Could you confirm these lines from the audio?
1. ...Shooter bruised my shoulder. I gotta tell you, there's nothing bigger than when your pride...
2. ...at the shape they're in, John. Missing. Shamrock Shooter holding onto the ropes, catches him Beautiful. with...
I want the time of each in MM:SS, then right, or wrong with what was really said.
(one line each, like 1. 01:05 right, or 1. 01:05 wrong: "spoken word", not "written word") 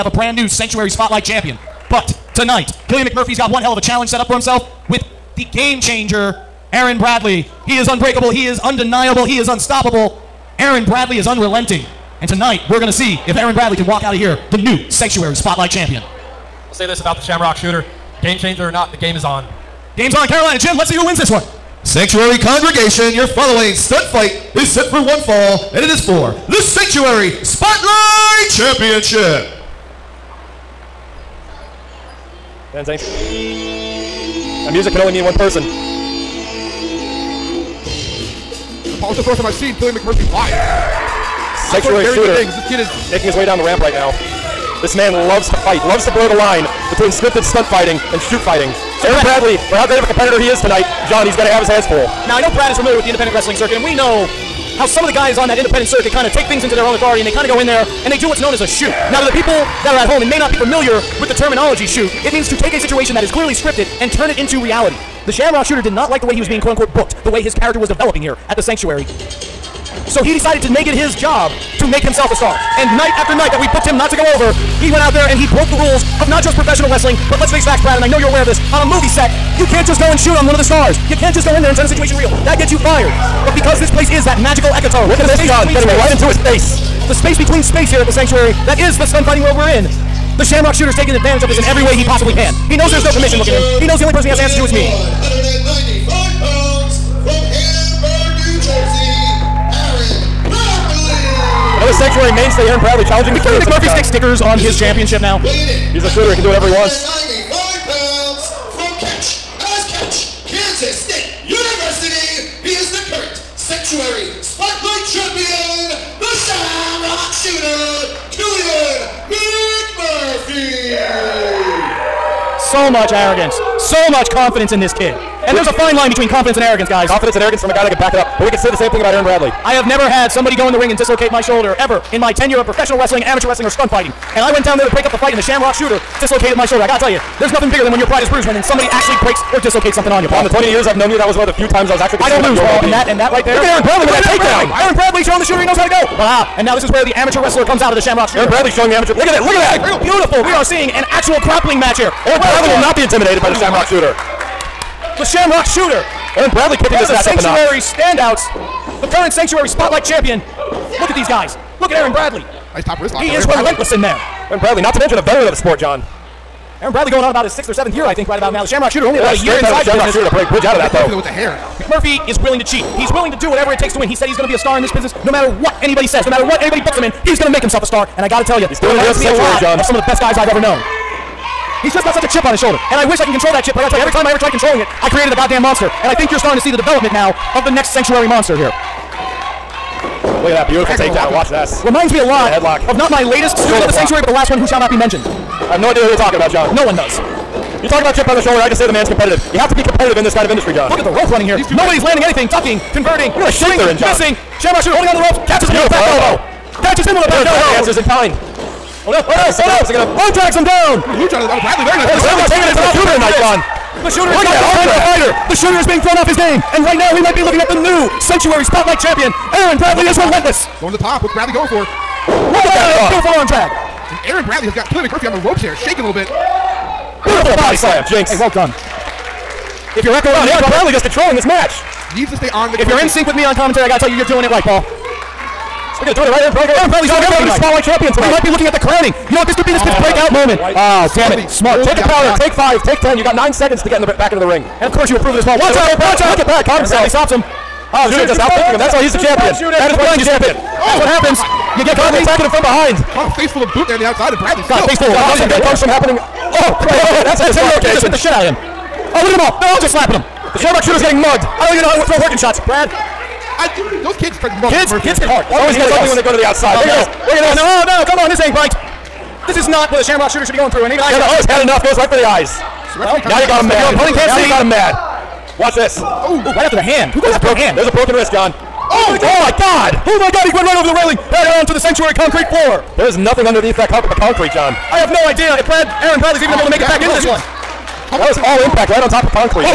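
1. 02:15 wrong: "dislocated", not "bruised"
2. 03:23 right.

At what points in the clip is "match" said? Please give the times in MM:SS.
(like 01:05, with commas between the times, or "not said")
02:31, 02:37, 03:51.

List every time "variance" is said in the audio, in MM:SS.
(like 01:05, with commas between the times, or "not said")
not said.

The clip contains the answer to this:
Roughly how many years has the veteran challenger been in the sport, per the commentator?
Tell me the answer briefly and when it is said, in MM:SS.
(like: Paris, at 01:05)
sixth or seventh, at 02:47.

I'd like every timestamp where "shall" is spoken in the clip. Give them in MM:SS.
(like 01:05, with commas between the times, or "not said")
03:14.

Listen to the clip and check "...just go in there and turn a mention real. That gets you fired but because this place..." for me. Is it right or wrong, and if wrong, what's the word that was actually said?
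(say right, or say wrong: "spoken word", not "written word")
wrong: "situation", not "mention".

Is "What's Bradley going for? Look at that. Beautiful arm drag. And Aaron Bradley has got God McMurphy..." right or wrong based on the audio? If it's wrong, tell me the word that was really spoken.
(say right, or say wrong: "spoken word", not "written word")
wrong: "Killian", not "God".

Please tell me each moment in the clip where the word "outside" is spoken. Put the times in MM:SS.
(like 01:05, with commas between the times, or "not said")
04:14, 04:26.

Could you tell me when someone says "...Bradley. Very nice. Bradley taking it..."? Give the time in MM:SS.
03:31.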